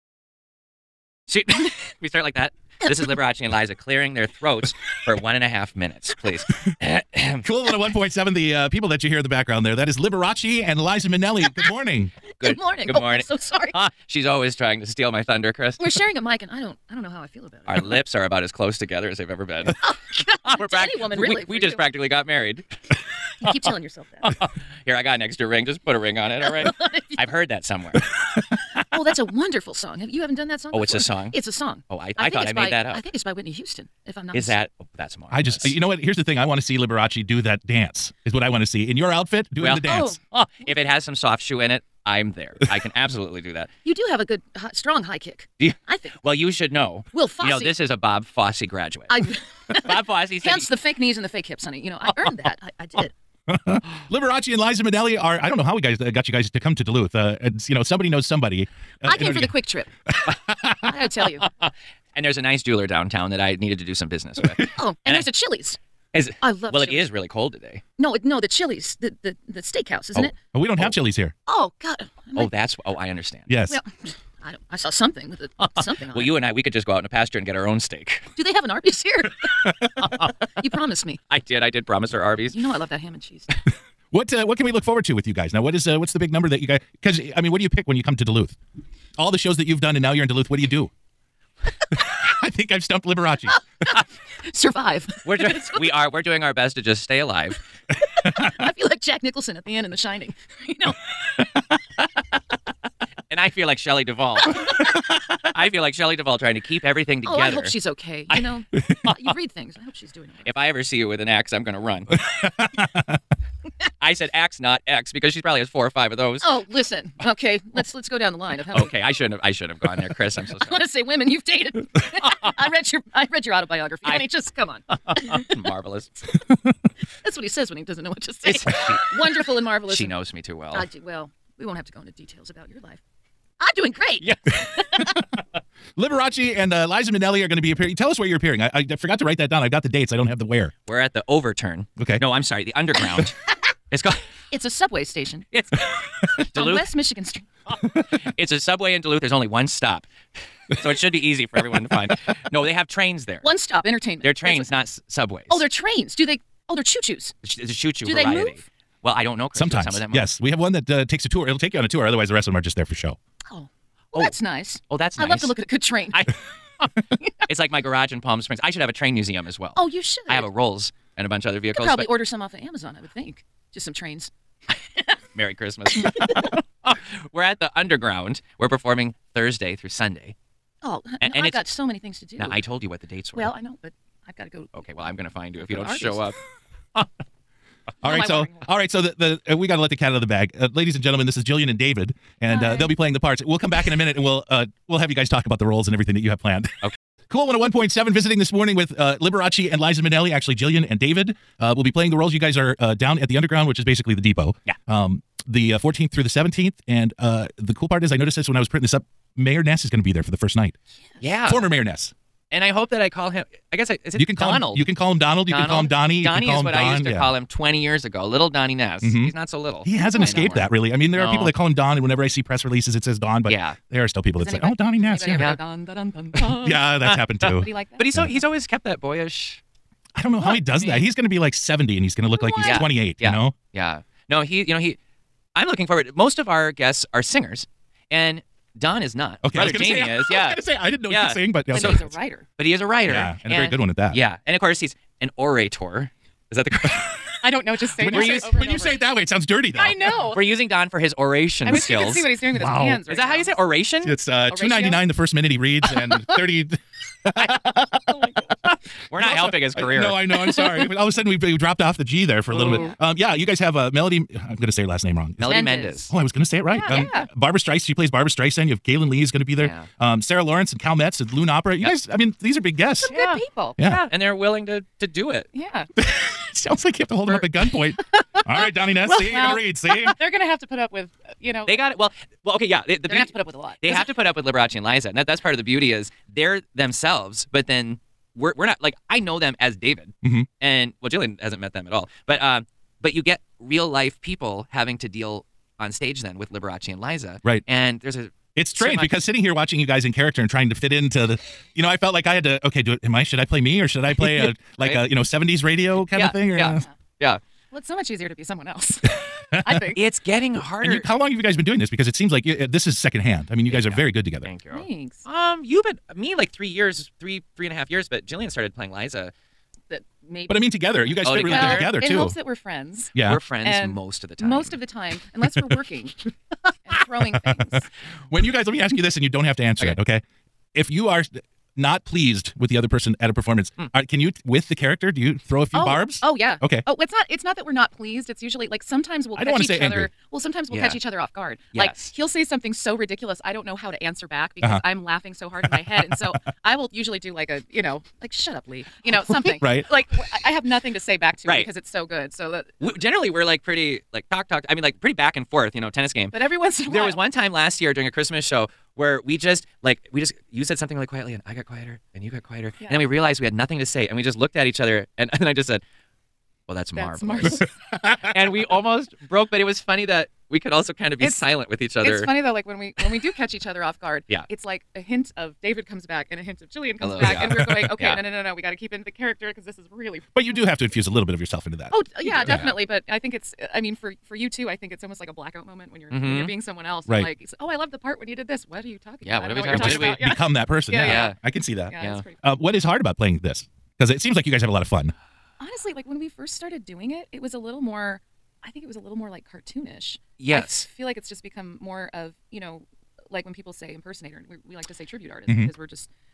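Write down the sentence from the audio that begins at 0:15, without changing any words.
We're sharing a mic, and I don't, I don't know how I feel about it.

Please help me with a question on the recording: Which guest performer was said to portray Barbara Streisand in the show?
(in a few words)
Melody Mendez.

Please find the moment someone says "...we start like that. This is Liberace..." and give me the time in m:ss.
0:02.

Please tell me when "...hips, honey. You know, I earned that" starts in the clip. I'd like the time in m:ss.
0:51.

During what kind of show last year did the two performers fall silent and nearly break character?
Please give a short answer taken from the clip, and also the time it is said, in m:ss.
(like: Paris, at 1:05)
Christmas show, at 5:58.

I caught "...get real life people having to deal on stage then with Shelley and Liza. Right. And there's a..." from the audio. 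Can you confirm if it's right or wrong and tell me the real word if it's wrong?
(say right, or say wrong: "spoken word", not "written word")
wrong: "Liberace", not "Shelley".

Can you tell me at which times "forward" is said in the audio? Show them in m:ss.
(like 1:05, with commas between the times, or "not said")
1:24, 3:55.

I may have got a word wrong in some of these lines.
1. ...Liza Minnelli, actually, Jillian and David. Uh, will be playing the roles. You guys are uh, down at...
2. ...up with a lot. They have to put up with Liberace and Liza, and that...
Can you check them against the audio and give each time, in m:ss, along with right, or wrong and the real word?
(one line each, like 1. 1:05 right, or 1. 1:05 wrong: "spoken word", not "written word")
1. 3:19 right
2. 4:43 right.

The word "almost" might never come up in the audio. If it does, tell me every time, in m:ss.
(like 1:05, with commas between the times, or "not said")
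6:08, 6:25.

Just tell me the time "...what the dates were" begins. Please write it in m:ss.
3:02.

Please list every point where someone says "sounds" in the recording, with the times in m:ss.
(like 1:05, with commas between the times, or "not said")
4:09, 4:36.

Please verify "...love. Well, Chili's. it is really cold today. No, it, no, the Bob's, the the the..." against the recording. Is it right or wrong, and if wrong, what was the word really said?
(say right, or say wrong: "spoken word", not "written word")
wrong: "Chili", not "Bob".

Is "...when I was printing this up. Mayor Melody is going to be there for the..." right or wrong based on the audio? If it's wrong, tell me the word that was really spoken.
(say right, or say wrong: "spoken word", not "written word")
wrong: "Ness", not "Melody".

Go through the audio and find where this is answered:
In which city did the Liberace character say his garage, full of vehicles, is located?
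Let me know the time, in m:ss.
2:48.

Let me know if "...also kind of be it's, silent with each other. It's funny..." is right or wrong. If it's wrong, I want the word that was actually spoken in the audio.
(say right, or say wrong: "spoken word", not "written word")
right.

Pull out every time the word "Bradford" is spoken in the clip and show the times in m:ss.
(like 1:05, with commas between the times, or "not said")
not said.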